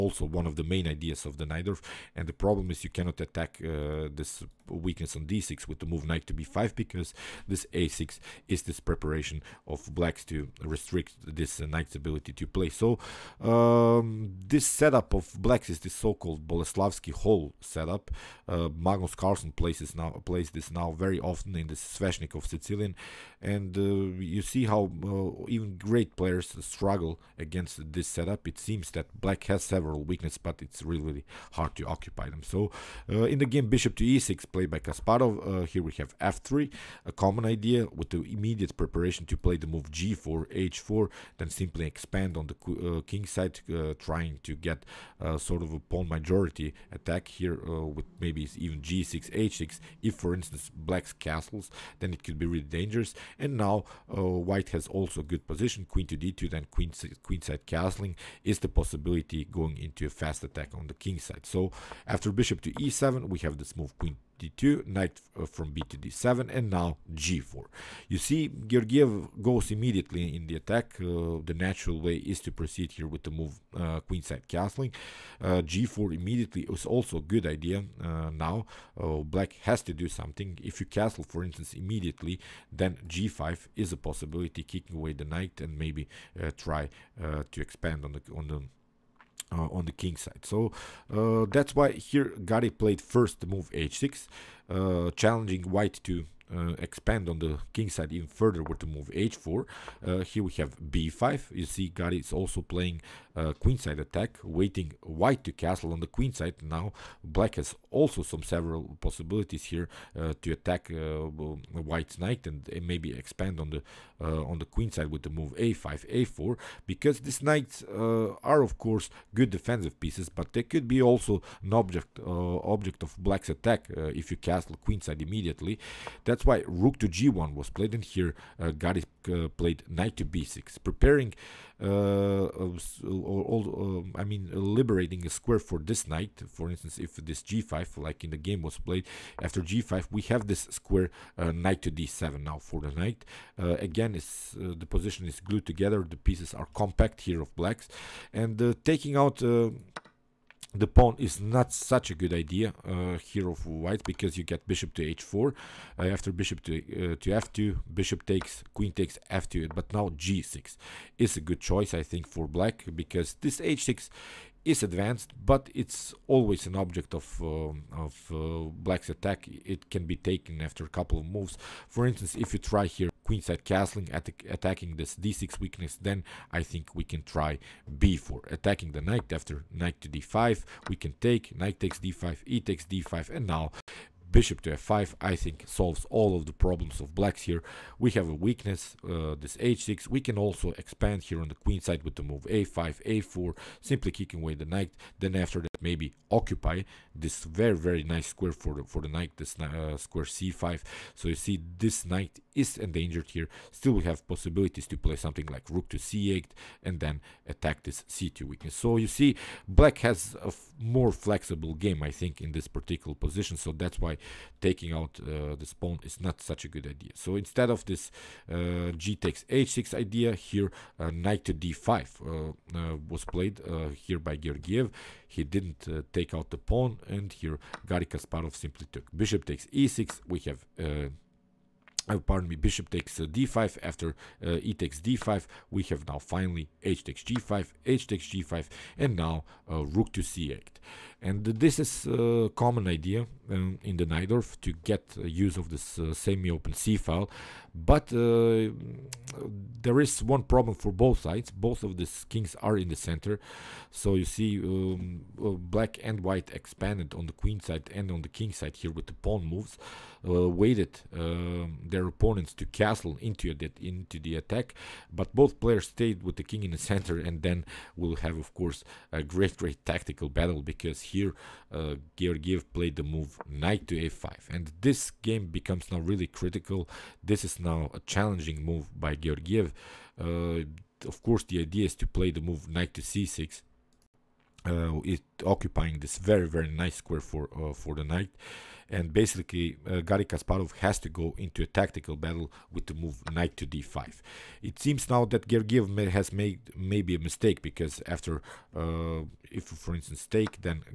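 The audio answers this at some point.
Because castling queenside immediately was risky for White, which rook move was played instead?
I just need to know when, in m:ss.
2:06.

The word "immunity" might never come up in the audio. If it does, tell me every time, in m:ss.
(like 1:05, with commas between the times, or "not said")
not said.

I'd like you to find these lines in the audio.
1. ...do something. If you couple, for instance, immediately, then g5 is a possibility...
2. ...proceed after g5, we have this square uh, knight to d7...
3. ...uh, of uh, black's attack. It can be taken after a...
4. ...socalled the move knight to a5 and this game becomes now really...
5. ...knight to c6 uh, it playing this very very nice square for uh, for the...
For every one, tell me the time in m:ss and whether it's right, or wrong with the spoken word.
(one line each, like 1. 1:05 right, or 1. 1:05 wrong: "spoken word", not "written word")
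1. 1:19 wrong: "castle", not "couple"
2. 2:18 wrong: "played", not "proceed"
3. 2:47 right
4. 4:32 wrong: "played", not "socalled"
5. 4:42 wrong: "occupying", not "playing".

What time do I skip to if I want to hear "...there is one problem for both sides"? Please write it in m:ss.
4:09.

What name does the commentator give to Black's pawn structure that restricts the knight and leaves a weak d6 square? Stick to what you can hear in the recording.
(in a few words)
Boleslavsky hole.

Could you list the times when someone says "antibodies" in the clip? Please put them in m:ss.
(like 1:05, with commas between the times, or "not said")
not said.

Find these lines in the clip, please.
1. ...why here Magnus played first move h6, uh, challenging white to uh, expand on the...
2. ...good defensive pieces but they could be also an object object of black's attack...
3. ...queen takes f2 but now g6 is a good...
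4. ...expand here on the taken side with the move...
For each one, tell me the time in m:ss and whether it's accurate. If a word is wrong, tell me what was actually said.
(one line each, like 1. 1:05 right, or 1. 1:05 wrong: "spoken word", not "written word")
1. 1:31 wrong: "Garry", not "Magnus"
2. 1:59 right
3. 2:38 right
4. 3:10 wrong: "queen", not "taken".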